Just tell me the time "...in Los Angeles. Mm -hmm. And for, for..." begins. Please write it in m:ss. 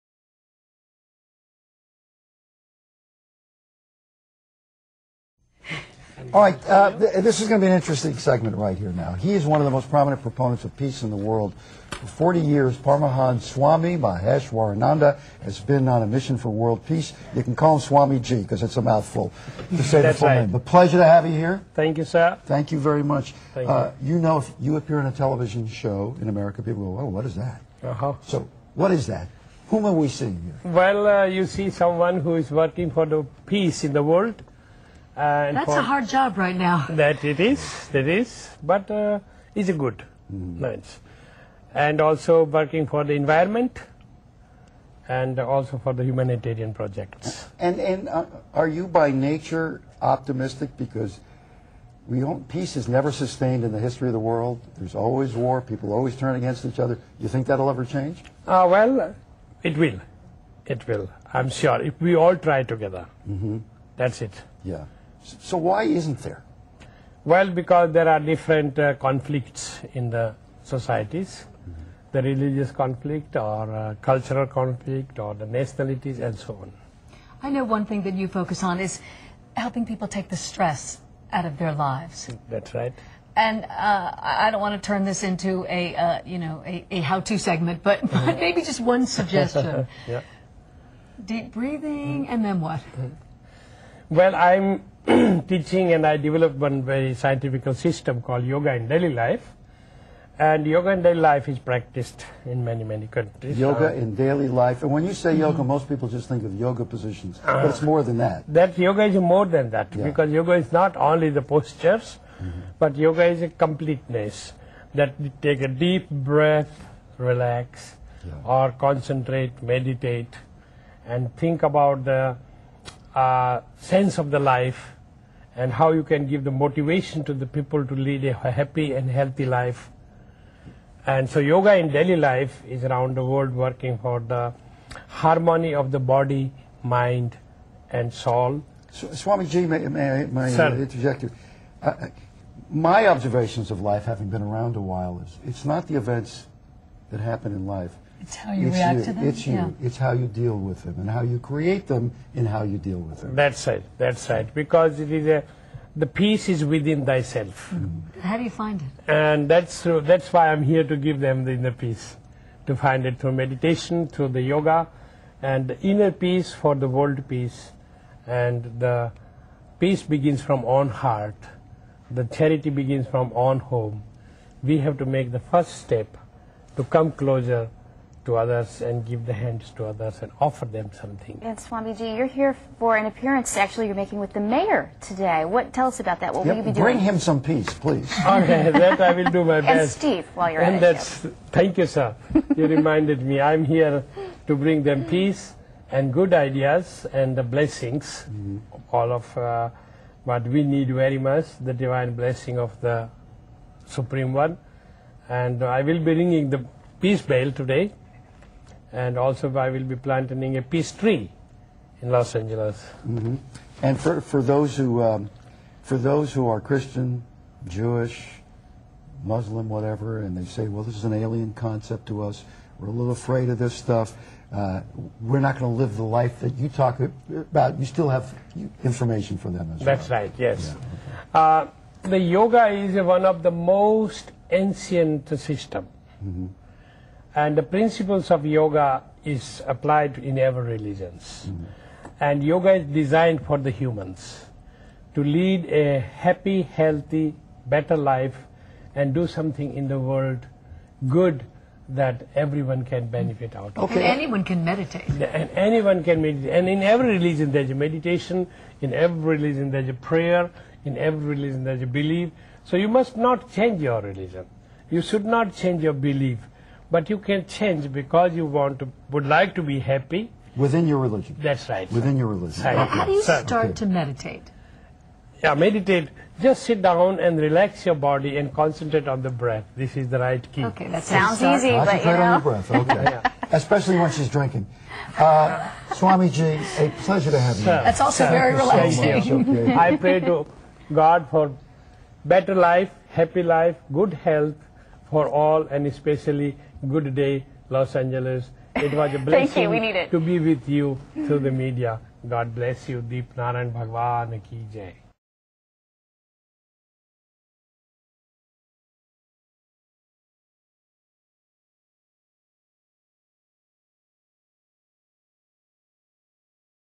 3:32.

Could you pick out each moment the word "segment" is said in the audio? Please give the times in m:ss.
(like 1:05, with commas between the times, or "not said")
0:08, 1:27.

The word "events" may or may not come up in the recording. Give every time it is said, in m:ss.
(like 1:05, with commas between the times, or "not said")
2:25.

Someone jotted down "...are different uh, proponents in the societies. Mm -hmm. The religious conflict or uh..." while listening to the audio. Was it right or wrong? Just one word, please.
wrong.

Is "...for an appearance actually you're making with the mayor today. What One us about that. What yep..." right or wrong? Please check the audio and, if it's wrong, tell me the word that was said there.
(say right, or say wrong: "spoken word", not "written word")
wrong: "Tell", not "One".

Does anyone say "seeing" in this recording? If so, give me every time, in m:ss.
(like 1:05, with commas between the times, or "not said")
0:30.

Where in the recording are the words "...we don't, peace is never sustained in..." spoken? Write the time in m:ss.
0:52.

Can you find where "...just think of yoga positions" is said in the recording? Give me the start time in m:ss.
1:46.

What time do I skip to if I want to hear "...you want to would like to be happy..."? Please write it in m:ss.
4:28.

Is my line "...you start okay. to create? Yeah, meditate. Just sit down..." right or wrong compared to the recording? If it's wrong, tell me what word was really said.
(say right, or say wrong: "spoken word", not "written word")
wrong: "meditate", not "create".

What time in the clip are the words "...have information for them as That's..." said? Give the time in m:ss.
3:48.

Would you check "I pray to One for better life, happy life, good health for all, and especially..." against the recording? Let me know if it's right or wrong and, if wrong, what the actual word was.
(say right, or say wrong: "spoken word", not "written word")
wrong: "God", not "One".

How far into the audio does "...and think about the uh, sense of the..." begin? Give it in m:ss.
2:01.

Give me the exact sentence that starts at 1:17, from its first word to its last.
I know one thing that you focus on is helping people take the stress out of their lives.